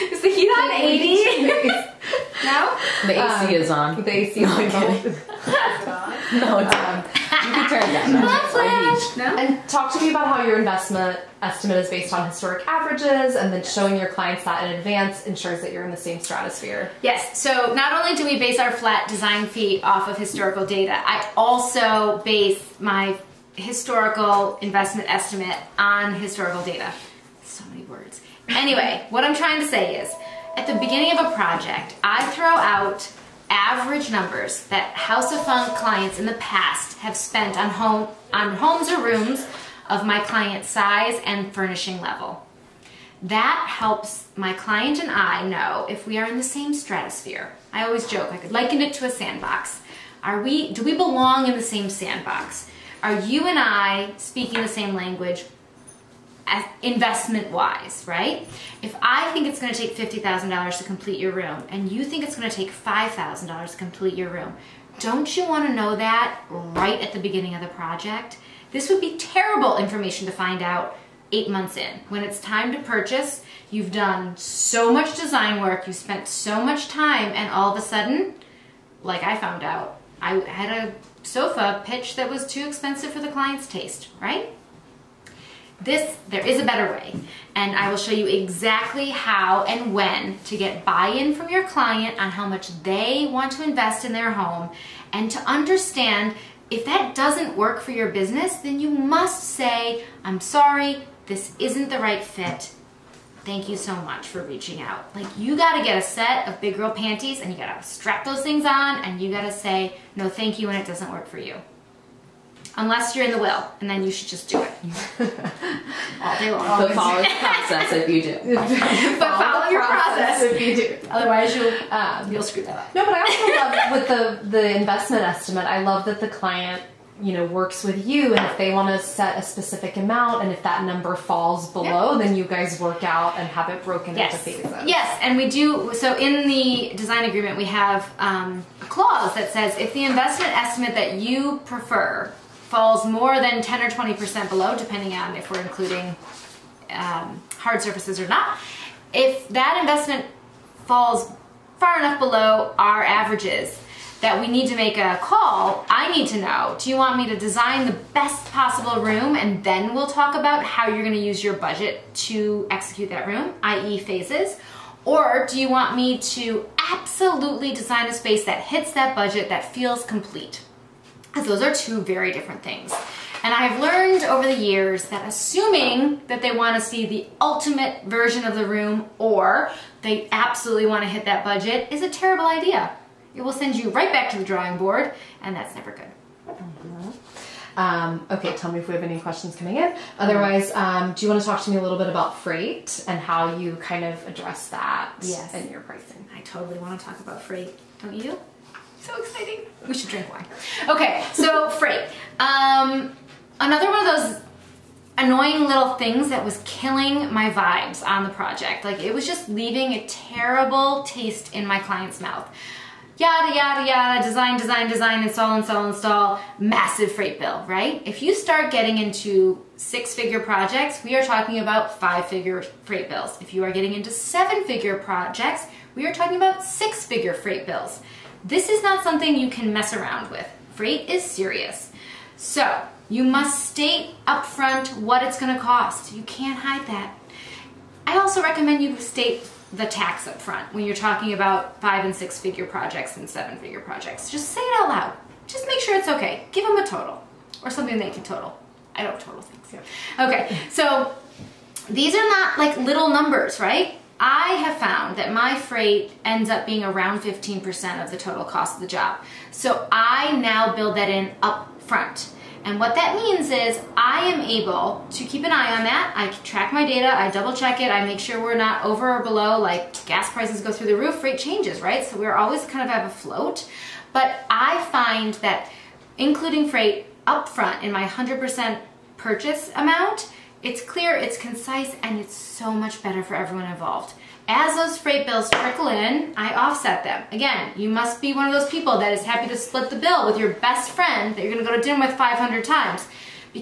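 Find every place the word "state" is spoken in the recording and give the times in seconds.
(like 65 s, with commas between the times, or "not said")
233 s, 238 s.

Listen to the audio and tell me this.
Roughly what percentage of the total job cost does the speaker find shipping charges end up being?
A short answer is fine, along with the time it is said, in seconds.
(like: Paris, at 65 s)
15%, at 257 s.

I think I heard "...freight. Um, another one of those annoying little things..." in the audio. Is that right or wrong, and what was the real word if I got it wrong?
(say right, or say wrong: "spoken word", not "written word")
right.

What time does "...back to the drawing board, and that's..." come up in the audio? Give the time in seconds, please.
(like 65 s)
184 s.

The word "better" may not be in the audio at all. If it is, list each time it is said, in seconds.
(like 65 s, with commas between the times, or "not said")
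86 s, 283 s.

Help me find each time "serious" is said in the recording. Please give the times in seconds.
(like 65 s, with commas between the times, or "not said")
231 s.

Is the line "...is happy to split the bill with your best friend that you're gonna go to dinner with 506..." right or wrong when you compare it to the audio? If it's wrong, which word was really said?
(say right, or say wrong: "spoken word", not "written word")
wrong: "500", not "506".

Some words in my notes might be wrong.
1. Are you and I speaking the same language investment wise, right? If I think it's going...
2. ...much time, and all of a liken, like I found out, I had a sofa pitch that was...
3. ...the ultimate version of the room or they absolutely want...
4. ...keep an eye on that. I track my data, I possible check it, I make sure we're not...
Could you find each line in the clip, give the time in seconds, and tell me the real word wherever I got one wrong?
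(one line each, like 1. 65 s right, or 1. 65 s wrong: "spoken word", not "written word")
1. 53 s right
2. 76 s wrong: "sudden", not "liken"
3. 177 s right
4. 265 s wrong: "double", not "possible".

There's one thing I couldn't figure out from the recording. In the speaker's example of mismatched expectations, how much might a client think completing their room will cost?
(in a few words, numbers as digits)
$5,000.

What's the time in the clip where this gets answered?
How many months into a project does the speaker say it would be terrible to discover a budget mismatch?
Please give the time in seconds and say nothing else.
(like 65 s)
71 s.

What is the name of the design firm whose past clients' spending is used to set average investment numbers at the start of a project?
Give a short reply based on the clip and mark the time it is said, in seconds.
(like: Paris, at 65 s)
House of Funk, at 34 s.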